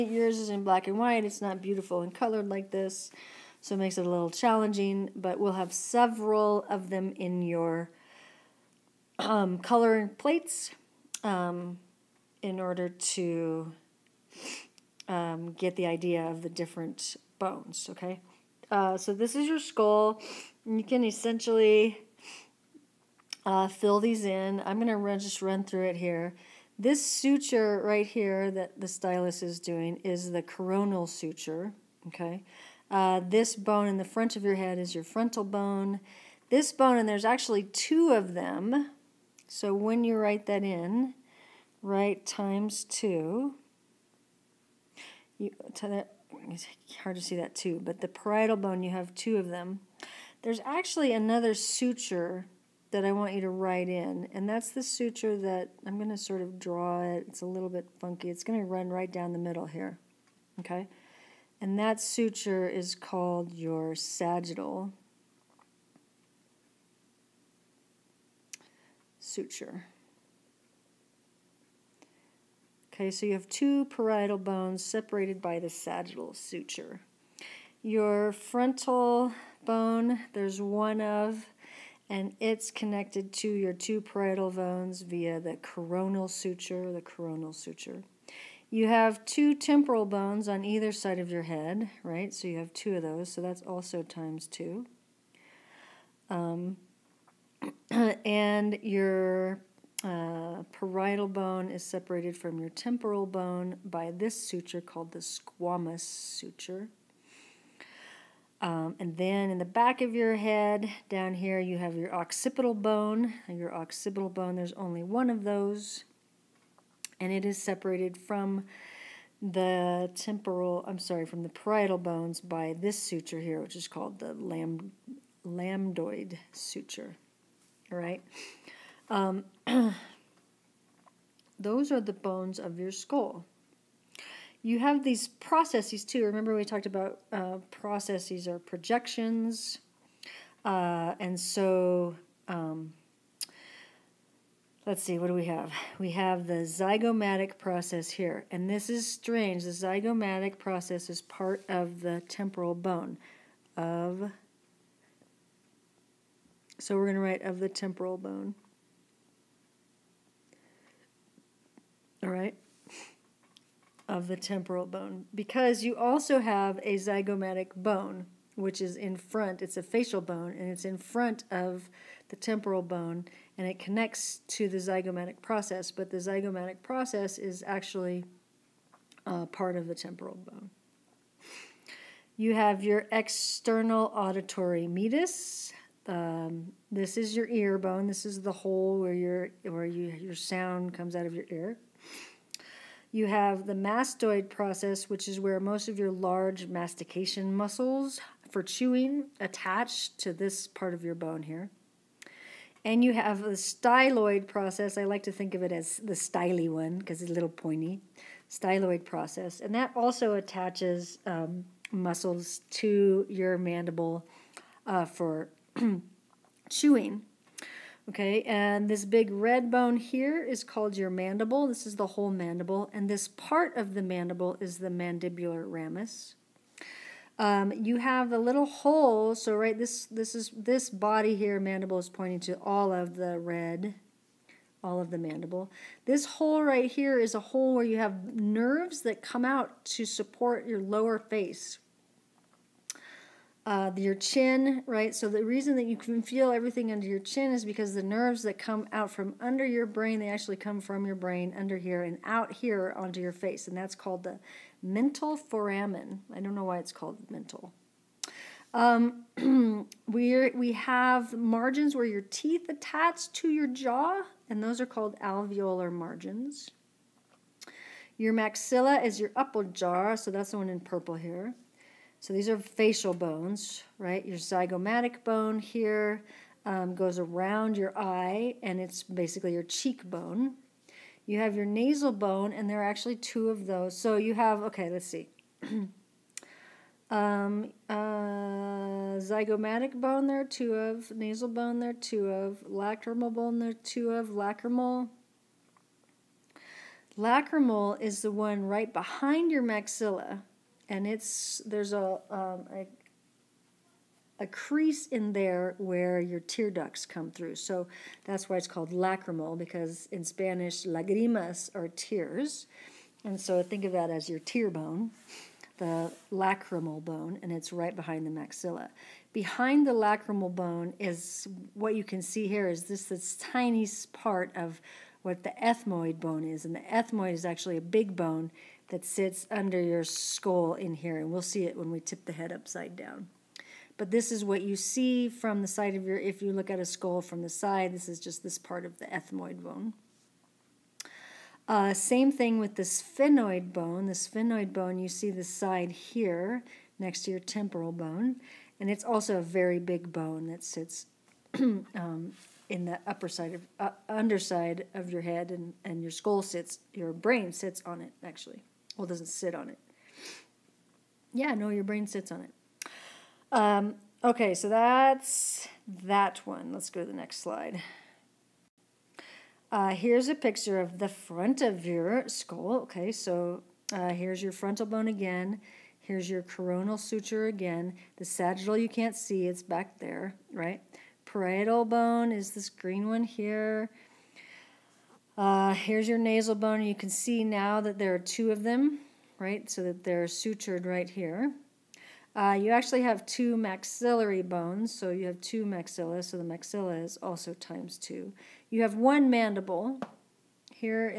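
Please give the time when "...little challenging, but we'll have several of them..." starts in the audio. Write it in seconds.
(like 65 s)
4 s.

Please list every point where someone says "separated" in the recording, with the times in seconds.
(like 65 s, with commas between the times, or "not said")
74 s, 101 s, 117 s.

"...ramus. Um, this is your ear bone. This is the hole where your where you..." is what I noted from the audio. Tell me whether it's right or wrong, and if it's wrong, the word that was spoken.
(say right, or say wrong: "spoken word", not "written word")
wrong: "meatus", not "ramus".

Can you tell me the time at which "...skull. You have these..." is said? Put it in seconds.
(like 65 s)
132 s.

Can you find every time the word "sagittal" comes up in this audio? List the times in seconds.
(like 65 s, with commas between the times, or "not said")
63 s, 75 s, 378 s.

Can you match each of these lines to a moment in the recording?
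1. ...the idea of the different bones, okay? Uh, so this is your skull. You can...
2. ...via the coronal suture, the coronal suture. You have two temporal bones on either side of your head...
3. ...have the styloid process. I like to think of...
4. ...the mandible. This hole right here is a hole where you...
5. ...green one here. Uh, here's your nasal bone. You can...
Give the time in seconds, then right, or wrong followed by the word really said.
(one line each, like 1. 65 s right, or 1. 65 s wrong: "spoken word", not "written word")
1. 15 s right
2. 85 s right
3. 203 s right
4. 235 s right
5. 382 s right.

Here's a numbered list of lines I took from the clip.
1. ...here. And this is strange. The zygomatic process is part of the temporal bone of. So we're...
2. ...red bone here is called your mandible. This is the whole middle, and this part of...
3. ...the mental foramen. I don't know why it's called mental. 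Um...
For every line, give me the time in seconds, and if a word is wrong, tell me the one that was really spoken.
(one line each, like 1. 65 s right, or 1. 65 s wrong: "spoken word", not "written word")
1. 148 s right
2. 219 s wrong: "mandible", not "middle"
3. 254 s right.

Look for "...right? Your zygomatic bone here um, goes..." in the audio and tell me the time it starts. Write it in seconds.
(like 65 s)
273 s.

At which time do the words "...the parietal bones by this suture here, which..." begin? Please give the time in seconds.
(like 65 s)
121 s.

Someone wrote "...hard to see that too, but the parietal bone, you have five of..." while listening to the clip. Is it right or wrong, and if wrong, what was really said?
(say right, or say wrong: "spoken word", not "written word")
wrong: "two", not "five".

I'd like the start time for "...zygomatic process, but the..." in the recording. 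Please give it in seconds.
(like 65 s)
174 s.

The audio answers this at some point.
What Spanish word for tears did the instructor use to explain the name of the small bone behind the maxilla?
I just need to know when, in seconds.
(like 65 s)
310 s.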